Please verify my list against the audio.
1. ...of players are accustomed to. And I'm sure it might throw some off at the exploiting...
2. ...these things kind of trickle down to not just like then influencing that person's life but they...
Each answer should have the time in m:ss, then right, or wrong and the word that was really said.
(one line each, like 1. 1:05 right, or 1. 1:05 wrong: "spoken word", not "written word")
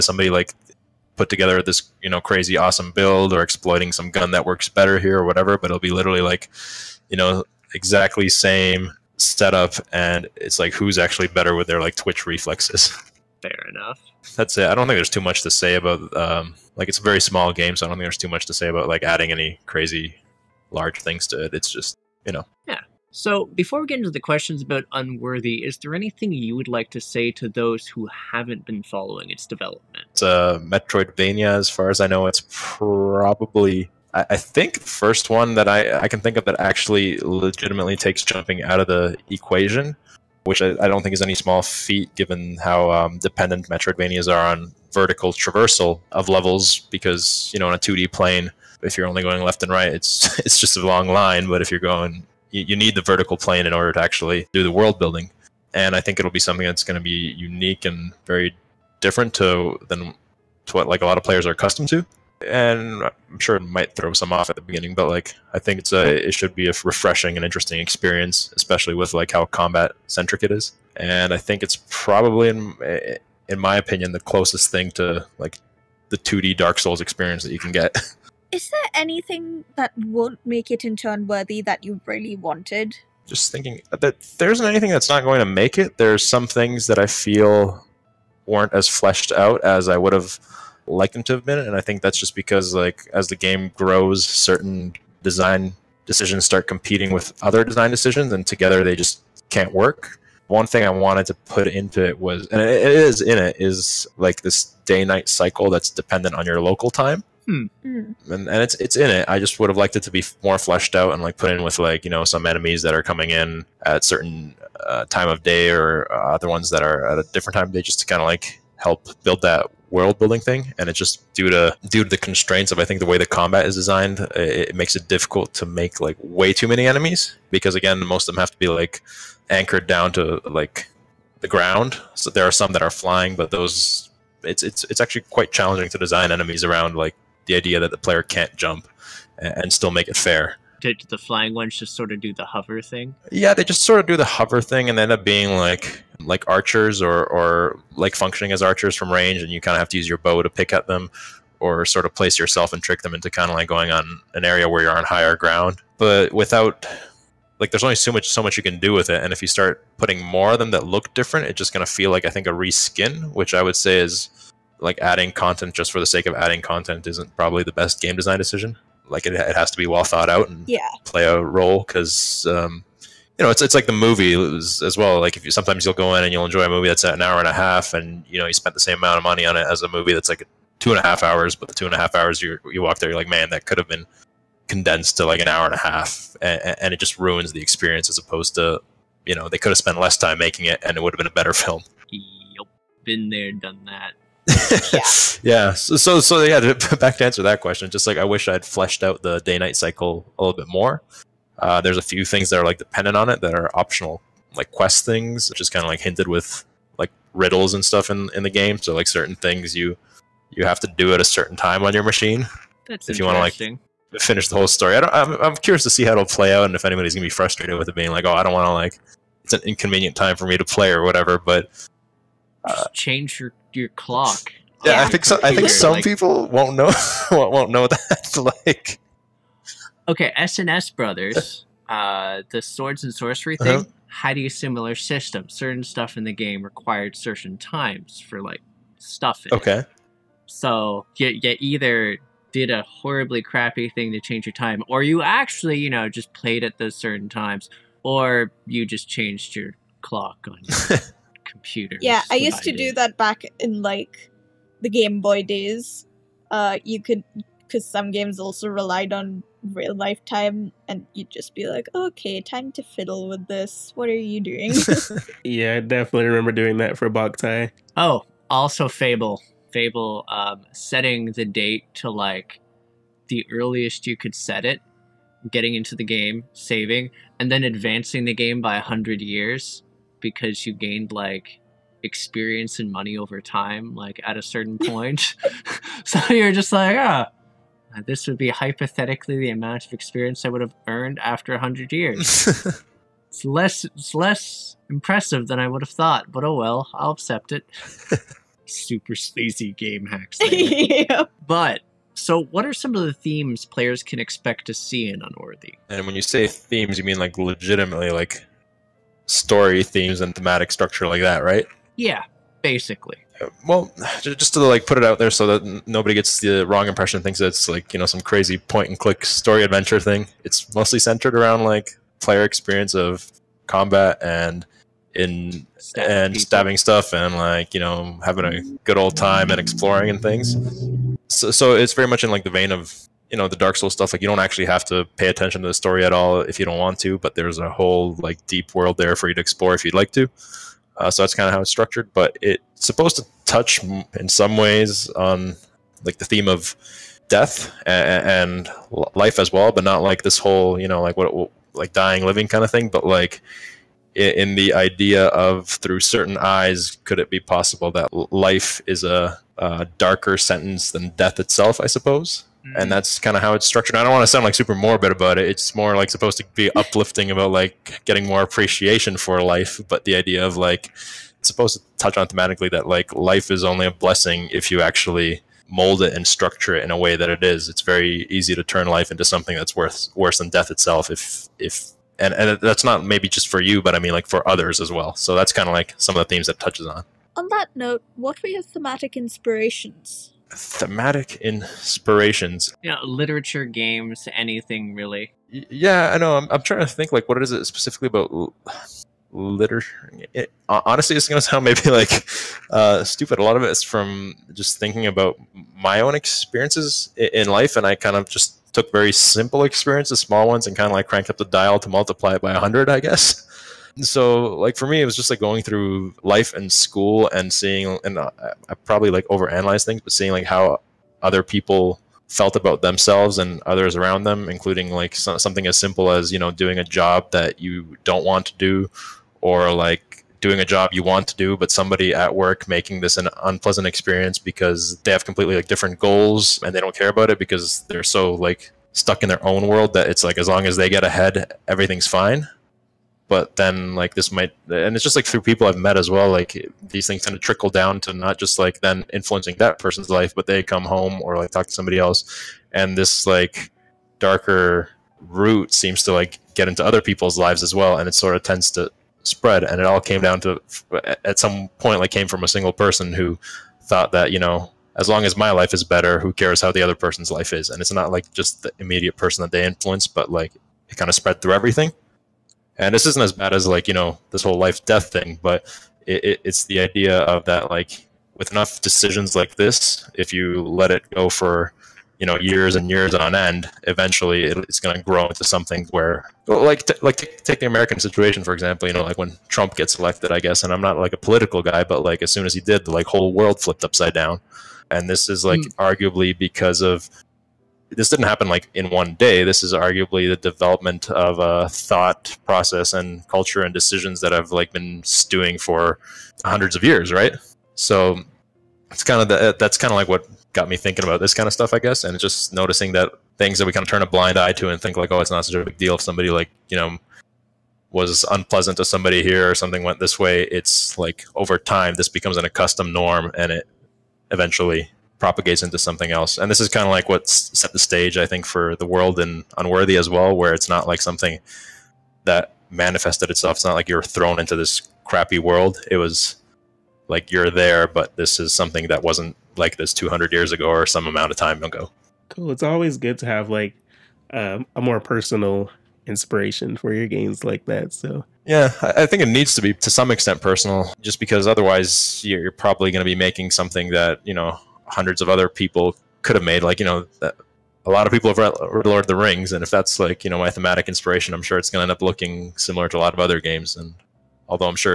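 1. 1:01 wrong: "beginning", not "exploiting"
2. 7:26 right.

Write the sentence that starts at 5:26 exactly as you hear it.
stabbing stuff and like you know having a good old time and exploring and things.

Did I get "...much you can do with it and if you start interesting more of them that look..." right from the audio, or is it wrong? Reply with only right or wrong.
wrong.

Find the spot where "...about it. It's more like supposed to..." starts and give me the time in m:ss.
6:05.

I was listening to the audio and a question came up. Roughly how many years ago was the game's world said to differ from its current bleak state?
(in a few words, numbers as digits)
200.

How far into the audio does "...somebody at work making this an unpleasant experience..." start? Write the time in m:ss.
7:11.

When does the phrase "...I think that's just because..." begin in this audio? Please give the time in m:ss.
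1:31.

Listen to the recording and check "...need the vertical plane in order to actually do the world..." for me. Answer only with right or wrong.
right.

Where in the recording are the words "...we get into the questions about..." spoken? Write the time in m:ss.
0:23.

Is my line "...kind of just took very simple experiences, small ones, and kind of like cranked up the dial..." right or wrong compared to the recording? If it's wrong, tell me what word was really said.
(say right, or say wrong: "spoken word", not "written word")
right.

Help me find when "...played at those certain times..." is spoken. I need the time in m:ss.
4:06.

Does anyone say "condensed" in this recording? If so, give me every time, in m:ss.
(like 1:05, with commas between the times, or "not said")
3:04.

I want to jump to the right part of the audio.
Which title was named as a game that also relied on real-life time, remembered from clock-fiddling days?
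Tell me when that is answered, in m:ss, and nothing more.
4:27.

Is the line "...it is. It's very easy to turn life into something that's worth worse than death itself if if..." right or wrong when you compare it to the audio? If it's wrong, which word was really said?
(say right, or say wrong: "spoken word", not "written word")
right.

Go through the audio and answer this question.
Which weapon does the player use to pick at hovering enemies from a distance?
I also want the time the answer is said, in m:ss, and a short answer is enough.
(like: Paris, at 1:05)
Bow, at 2:30.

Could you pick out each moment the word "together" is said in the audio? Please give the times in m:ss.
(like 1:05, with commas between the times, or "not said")
0:01, 1:38.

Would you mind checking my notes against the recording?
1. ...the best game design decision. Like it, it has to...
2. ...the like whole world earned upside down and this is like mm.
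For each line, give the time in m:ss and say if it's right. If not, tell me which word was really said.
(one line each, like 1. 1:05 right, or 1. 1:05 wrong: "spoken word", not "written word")
1. 2:47 right
2. 8:12 wrong: "flipped", not "earned".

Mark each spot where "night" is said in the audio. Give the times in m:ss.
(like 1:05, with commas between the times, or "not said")
1:45, 3:19.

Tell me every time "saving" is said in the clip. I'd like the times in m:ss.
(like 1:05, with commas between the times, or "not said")
4:36.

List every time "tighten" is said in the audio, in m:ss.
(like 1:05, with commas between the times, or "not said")
not said.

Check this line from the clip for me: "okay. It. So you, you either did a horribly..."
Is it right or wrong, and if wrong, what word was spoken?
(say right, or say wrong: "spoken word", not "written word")
right.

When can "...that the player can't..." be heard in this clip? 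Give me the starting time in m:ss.
2:17.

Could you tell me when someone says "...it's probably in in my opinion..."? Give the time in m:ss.
1:11.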